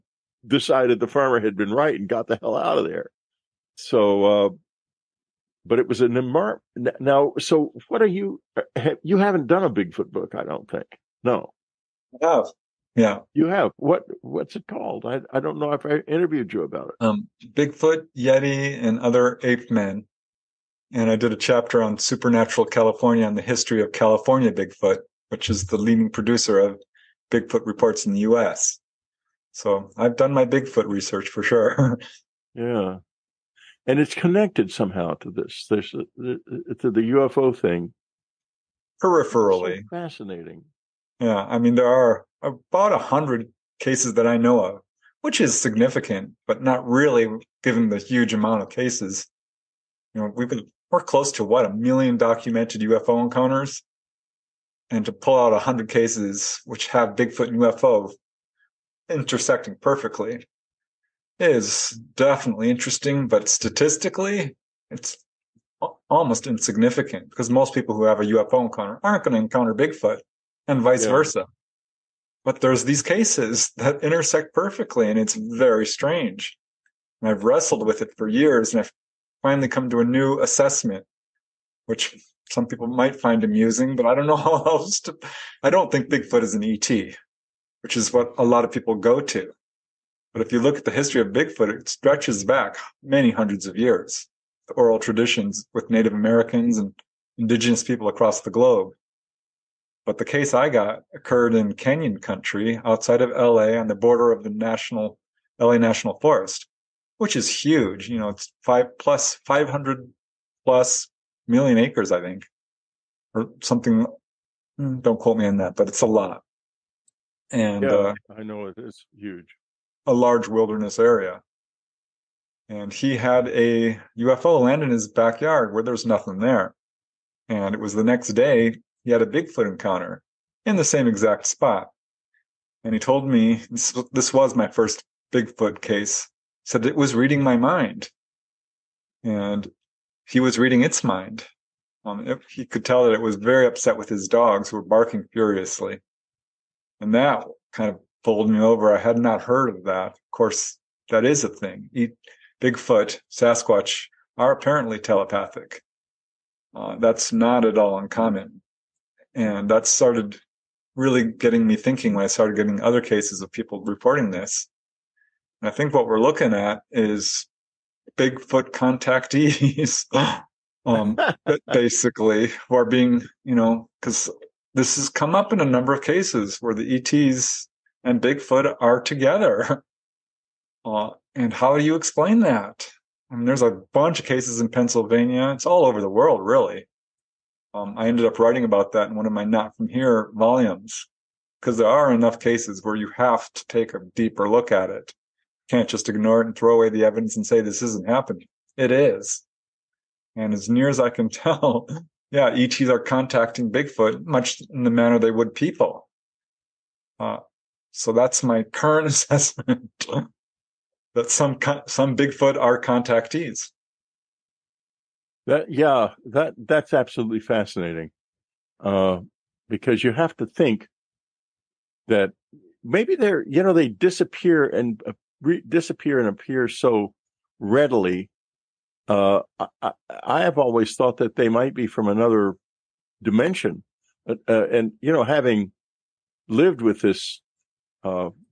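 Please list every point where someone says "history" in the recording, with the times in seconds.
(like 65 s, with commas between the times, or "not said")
23 s, 90 s.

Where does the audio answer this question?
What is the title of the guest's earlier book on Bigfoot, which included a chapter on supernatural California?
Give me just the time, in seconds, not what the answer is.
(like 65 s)
17 s.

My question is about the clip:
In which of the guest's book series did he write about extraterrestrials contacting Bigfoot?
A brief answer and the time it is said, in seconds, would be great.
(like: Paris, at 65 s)
Not From Here, at 189 s.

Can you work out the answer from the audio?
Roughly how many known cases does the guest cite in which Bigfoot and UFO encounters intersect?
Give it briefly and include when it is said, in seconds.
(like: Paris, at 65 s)
100, at 42 s.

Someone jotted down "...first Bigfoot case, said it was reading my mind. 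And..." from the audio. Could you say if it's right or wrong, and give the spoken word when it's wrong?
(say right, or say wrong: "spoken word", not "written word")
right.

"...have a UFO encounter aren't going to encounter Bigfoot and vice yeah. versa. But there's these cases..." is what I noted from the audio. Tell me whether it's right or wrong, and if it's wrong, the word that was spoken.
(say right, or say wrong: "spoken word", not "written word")
right.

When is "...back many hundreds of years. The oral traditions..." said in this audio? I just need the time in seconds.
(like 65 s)
92 s.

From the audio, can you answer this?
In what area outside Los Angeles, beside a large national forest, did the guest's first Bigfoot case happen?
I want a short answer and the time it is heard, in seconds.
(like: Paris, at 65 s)
Canyon country, at 101 s.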